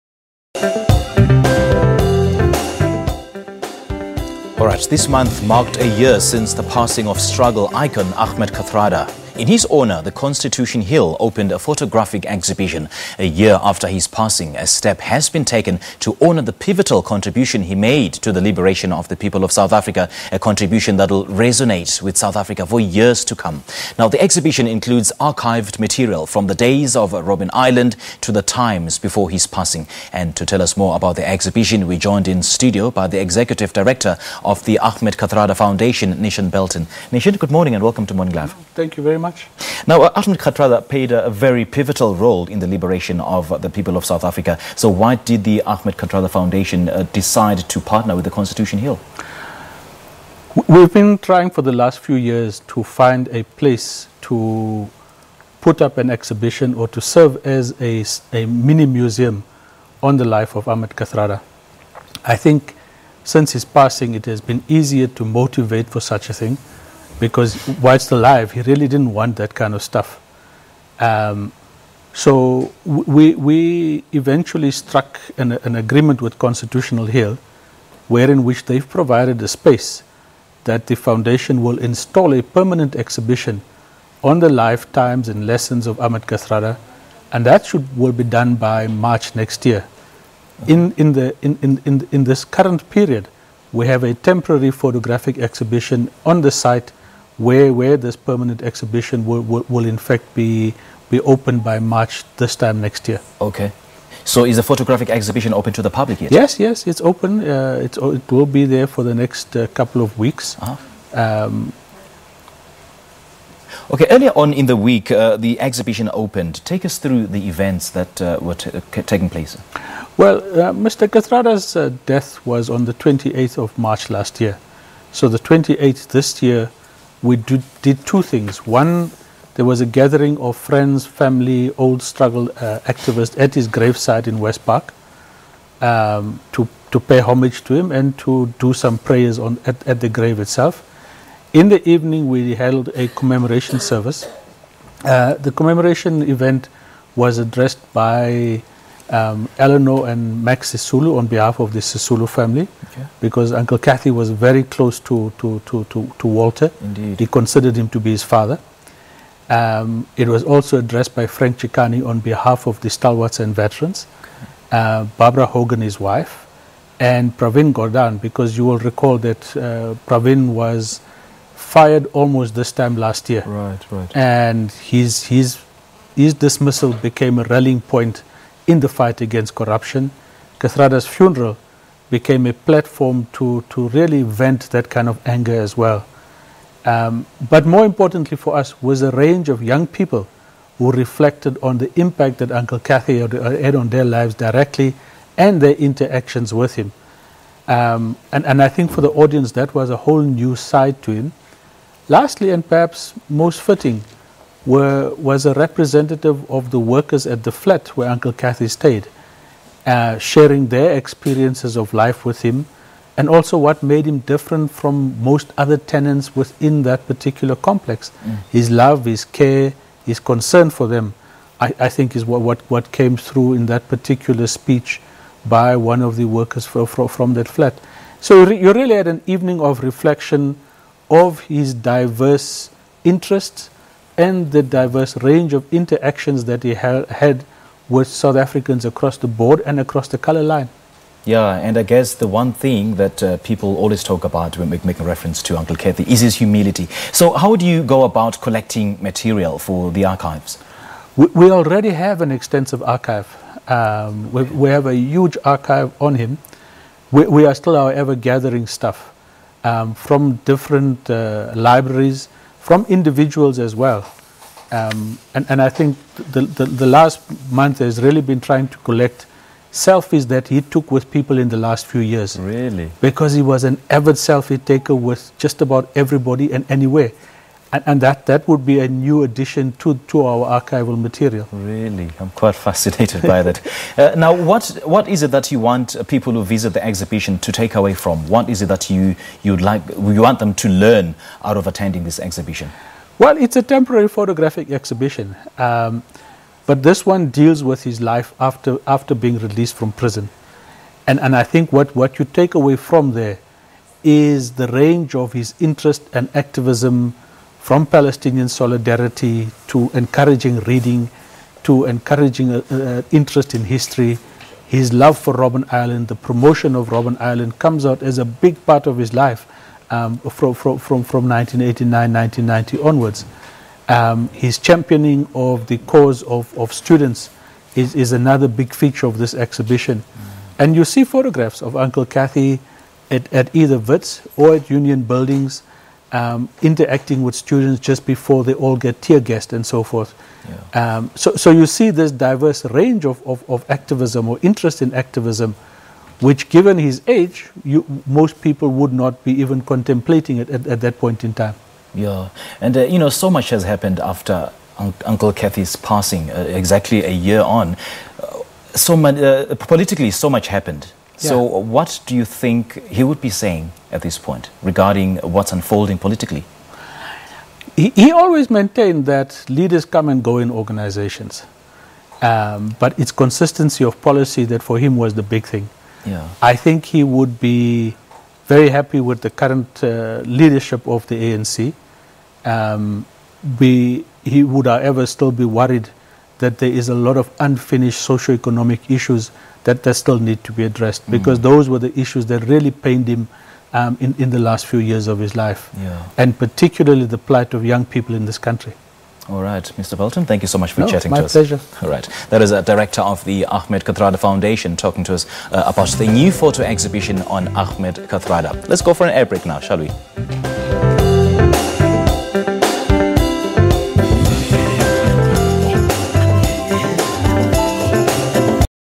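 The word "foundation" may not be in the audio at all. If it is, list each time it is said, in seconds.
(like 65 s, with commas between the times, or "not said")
35 s, 46 s, 80 s, 404 s.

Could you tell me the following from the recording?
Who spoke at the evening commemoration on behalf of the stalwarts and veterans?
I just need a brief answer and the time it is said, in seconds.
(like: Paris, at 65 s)
Frank Chikane, at 161 s.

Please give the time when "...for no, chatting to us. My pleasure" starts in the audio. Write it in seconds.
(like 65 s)
400 s.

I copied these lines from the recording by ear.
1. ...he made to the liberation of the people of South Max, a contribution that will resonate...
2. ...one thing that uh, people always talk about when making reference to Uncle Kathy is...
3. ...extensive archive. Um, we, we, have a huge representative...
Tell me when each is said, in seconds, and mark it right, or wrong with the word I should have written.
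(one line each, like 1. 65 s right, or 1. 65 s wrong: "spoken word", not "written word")
1. 17 s wrong: "Africa", not "Max"
2. 242 s right
3. 252 s wrong: "archive", not "representative".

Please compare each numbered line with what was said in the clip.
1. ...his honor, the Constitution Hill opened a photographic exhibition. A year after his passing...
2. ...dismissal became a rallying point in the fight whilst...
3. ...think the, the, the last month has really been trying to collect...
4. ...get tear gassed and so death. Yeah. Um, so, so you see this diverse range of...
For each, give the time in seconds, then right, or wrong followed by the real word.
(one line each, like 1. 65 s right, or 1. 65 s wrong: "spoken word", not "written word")
1. 9 s right
2. 176 s wrong: "against", not "whilst"
3. 265 s right
4. 338 s wrong: "forth", not "death".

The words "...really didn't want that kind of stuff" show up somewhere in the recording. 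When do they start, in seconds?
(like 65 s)
68 s.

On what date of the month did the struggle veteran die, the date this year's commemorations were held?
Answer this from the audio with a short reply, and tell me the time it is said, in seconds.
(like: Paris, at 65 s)
28th of March, at 123 s.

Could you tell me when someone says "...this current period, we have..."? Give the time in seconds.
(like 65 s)
92 s.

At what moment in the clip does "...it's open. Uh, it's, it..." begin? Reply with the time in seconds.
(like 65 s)
106 s.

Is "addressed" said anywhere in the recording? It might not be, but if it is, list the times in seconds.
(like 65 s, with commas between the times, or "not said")
147 s, 160 s, 390 s.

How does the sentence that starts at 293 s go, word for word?
Well, it's a temporary photographic exhibition, um, but this one deals with his life after, after being released from prison.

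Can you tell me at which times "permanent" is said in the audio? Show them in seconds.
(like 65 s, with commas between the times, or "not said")
82 s, 98 s.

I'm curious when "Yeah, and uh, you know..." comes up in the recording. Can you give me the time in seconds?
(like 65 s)
351 s.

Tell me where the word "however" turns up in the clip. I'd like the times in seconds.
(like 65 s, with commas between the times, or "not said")
257 s, 384 s.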